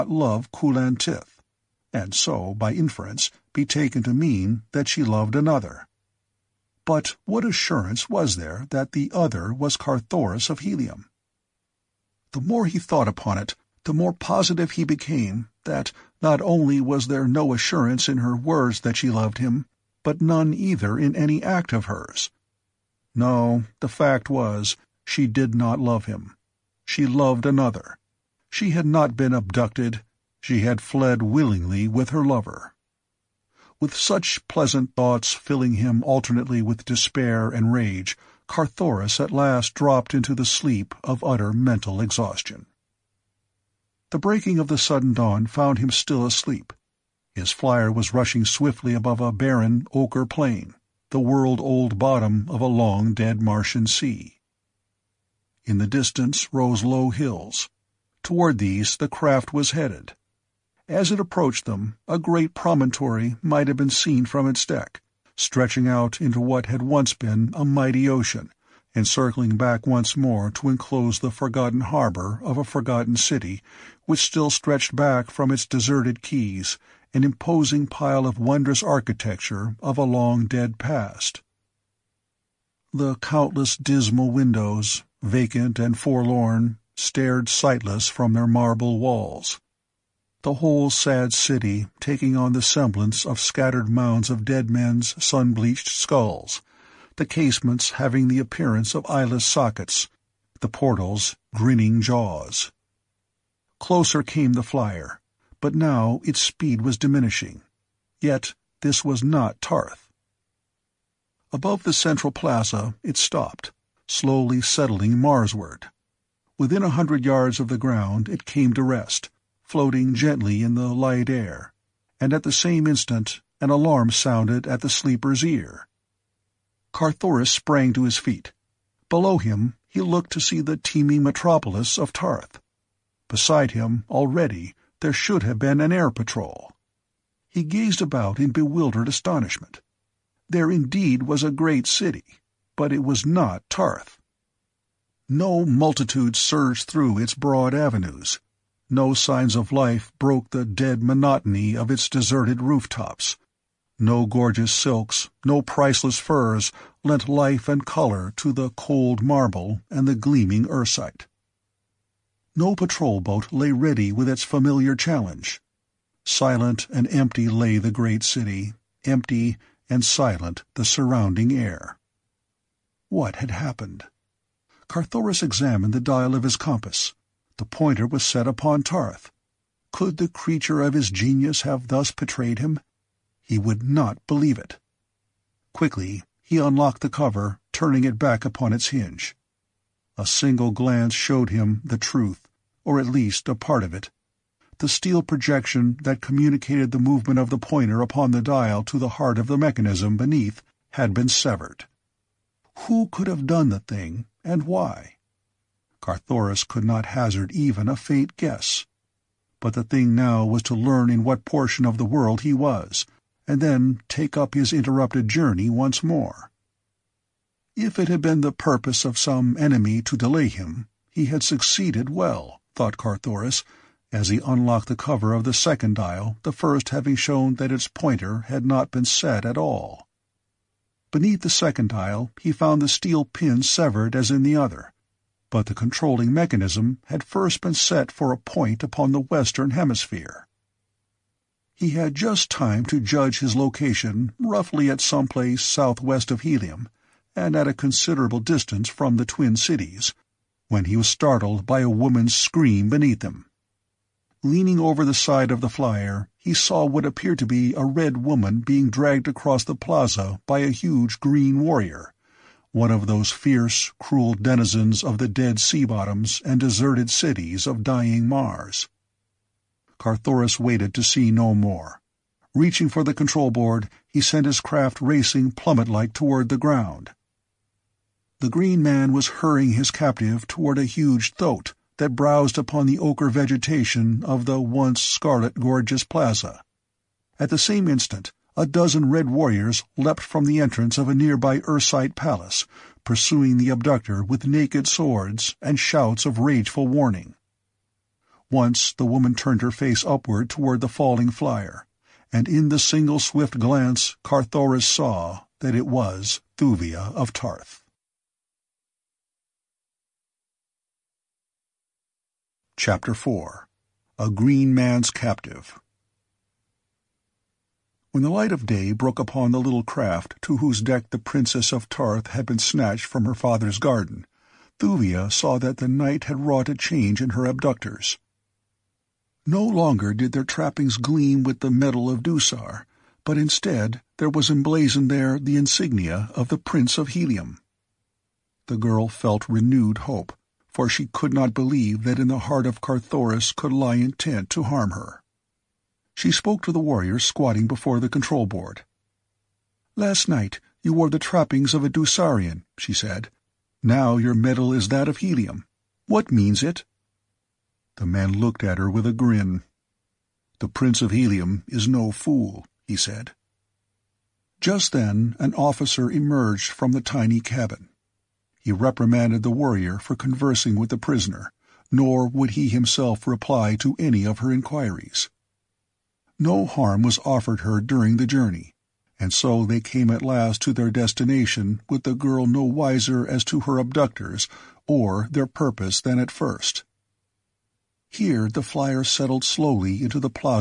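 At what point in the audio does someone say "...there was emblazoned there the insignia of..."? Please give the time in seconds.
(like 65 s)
334 s.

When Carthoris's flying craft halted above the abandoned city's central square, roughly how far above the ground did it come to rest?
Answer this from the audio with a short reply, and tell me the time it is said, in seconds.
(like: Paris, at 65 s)
100 yards, at 116 s.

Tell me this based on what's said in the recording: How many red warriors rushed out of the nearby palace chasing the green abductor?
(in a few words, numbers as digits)
12.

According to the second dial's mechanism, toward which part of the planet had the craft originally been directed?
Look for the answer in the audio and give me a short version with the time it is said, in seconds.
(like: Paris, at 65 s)
The western hemisphere, at 239 s.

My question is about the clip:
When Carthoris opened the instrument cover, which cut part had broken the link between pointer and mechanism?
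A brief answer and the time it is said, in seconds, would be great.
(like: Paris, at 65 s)
The steel projection, at 194 s.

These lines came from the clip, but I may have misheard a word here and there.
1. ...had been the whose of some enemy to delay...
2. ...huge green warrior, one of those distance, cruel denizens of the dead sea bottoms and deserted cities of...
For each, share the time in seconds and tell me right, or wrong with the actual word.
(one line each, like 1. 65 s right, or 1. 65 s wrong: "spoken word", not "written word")
1. 218 s wrong: "purpose", not "whose"
2. 260 s wrong: "fierce", not "distance".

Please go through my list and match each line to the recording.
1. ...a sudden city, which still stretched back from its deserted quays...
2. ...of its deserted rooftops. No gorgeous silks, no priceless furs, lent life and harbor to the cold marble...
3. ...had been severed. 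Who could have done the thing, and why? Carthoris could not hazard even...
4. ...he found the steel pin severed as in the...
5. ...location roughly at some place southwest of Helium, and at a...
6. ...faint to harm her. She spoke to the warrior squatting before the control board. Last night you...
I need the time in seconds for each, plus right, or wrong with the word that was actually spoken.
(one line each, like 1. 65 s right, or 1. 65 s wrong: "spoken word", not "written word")
1. 72 s wrong: "forgotten", not "sudden"
2. 151 s wrong: "color", not "harbor"
3. 200 s right
4. 232 s right
5. 243 s right
6. 343 s wrong: "intent", not "faint".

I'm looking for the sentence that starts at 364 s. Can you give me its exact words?
Just then an officer emerged from the tiny cabin.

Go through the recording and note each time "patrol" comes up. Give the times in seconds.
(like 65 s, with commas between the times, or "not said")
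136 s, 162 s.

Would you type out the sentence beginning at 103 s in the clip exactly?
Closer came the flyer, but now its speed was diminishing.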